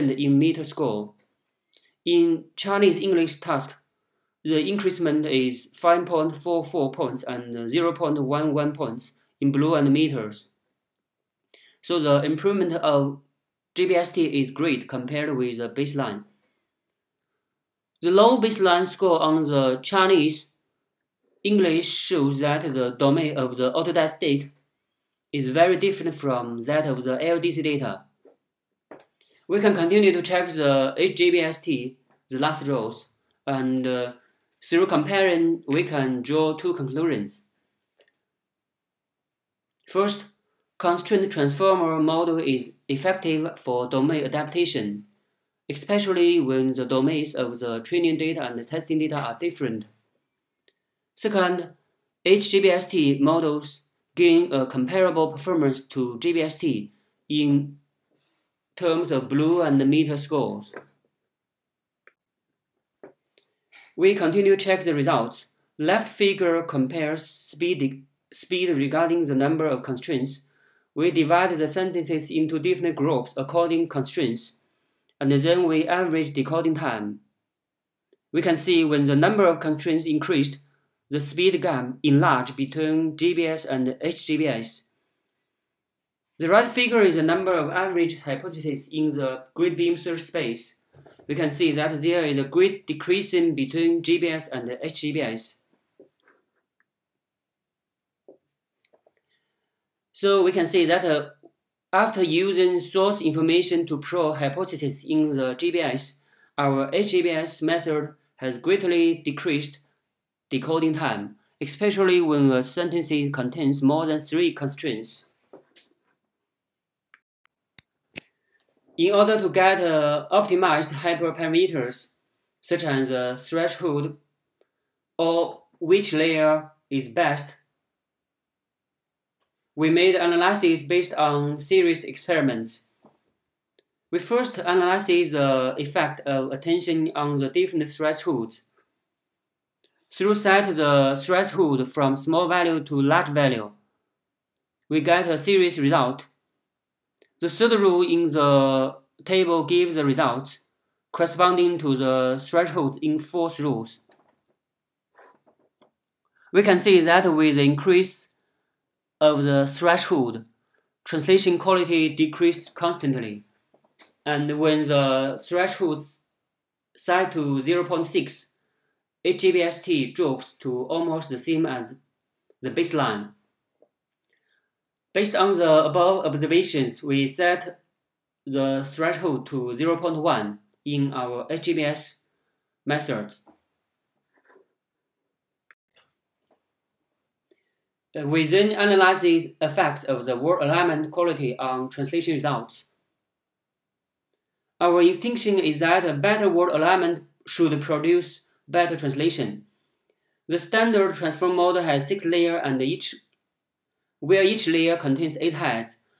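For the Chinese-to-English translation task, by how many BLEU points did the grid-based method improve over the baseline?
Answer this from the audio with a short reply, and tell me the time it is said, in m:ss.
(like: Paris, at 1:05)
5.44, at 0:05.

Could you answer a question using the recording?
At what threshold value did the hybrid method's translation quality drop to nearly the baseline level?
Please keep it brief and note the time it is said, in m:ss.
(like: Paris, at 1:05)
0.6, at 2:47.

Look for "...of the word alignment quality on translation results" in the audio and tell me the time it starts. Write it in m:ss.
3:10.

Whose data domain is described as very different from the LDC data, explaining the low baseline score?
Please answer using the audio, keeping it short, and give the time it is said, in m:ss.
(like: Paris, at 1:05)
Autodesk, at 0:23.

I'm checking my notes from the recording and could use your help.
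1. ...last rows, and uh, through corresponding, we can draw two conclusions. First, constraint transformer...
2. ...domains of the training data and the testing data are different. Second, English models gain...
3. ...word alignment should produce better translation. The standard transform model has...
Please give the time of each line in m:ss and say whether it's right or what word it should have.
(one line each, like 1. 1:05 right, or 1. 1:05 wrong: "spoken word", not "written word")
1. 0:32 wrong: "comparing", not "corresponding"
2. 0:46 wrong: "HGBST", not "English"
3. 3:16 right.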